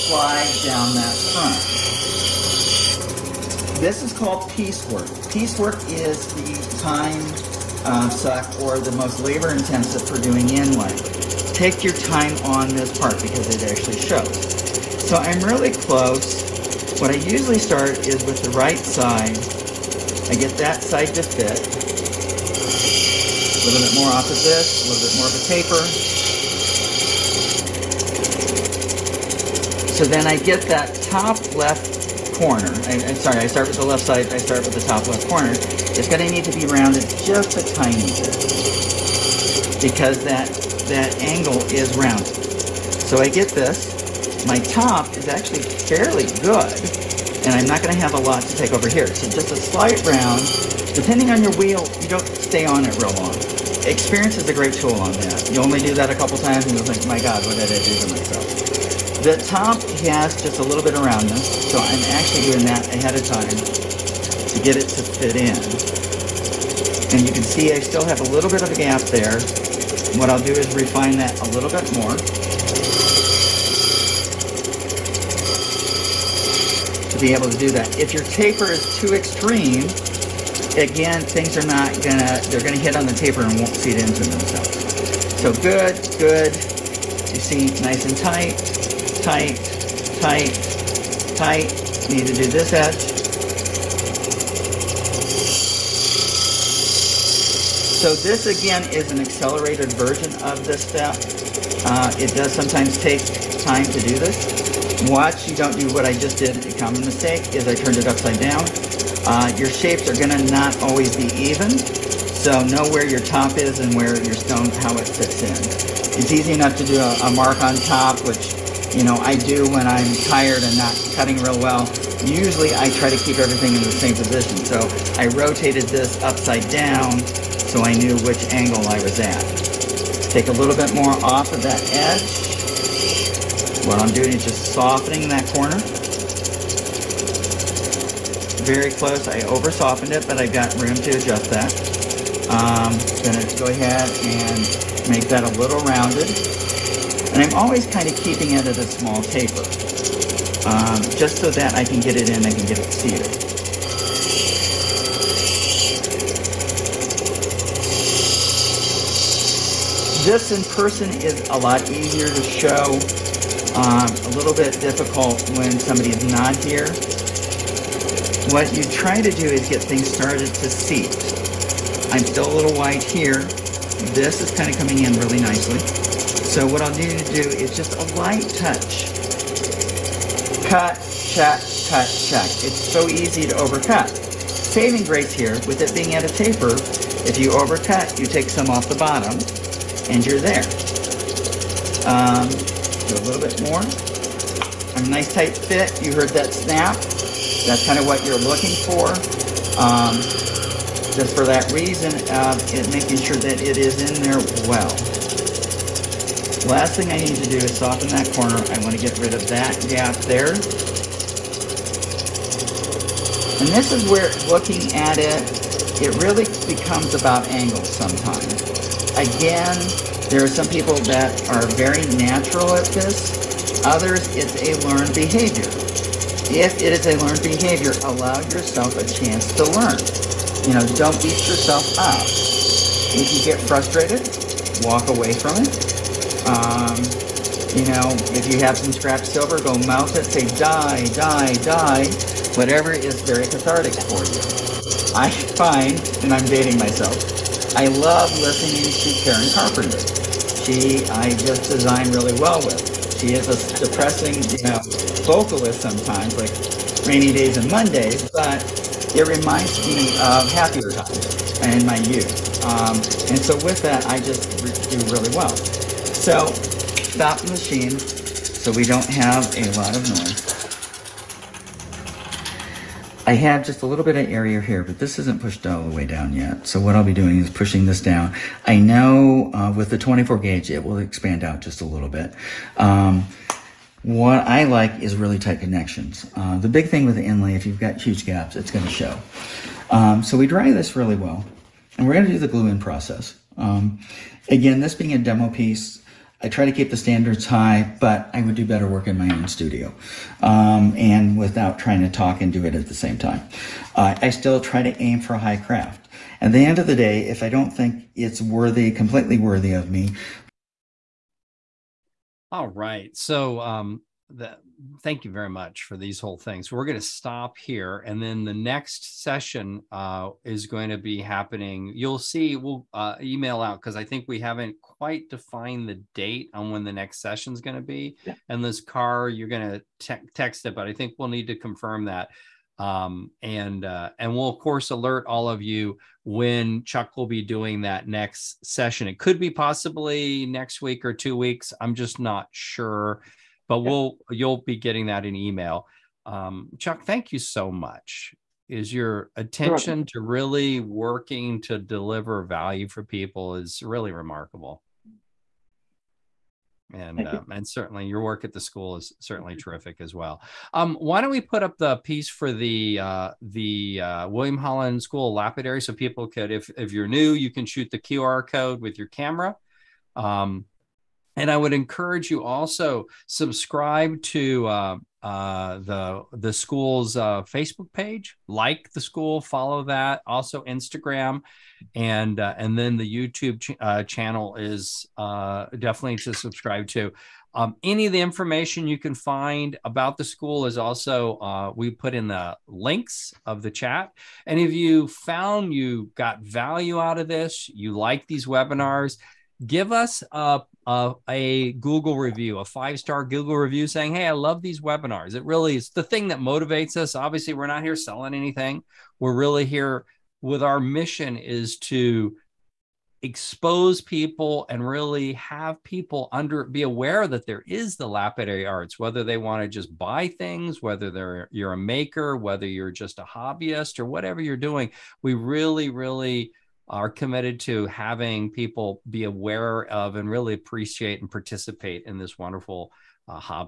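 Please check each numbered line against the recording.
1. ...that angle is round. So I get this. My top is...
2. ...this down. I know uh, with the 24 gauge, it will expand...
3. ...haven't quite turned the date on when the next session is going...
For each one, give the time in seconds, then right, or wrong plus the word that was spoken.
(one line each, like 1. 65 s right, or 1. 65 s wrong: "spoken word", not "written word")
1. 40 s right
2. 277 s right
3. 324 s wrong: "defined", not "turned".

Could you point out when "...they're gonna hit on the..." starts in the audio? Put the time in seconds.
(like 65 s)
82 s.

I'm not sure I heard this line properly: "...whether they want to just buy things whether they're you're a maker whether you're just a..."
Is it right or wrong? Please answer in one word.
right.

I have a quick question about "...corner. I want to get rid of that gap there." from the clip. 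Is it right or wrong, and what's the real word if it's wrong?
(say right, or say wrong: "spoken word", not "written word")
right.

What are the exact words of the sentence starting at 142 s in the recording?
Um, gonna go ahead and make that a little rounded.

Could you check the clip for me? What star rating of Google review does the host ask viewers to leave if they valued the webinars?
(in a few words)
5 star.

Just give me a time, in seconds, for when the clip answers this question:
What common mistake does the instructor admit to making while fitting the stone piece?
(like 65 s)
107 s.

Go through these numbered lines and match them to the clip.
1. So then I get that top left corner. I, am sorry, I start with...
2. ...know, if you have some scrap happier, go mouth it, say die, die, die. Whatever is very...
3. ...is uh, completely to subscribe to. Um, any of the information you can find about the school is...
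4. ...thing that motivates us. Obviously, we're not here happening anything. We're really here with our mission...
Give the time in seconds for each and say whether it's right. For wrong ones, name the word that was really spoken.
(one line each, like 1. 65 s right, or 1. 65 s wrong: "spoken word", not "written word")
1. 29 s right
2. 237 s wrong: "silver", not "happier"
3. 384 s wrong: "definitely", not "completely"
4. 406 s wrong: "selling", not "happening".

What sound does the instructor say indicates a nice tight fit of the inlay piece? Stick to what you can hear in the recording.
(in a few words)
Snap.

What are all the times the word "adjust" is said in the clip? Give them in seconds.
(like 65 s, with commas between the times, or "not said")
141 s.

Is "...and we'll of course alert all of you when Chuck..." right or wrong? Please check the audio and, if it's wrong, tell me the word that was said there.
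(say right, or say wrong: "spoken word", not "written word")
right.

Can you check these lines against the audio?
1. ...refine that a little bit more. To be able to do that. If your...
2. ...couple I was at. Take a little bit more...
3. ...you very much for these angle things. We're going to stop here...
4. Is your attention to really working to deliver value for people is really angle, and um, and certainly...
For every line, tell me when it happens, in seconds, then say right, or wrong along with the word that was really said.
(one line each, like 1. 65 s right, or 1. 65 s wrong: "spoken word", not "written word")
1. 70 s right
2. 128 s wrong: "angle", not "couple"
3. 315 s wrong: "whole", not "angle"
4. 348 s wrong: "remarkable", not "angle".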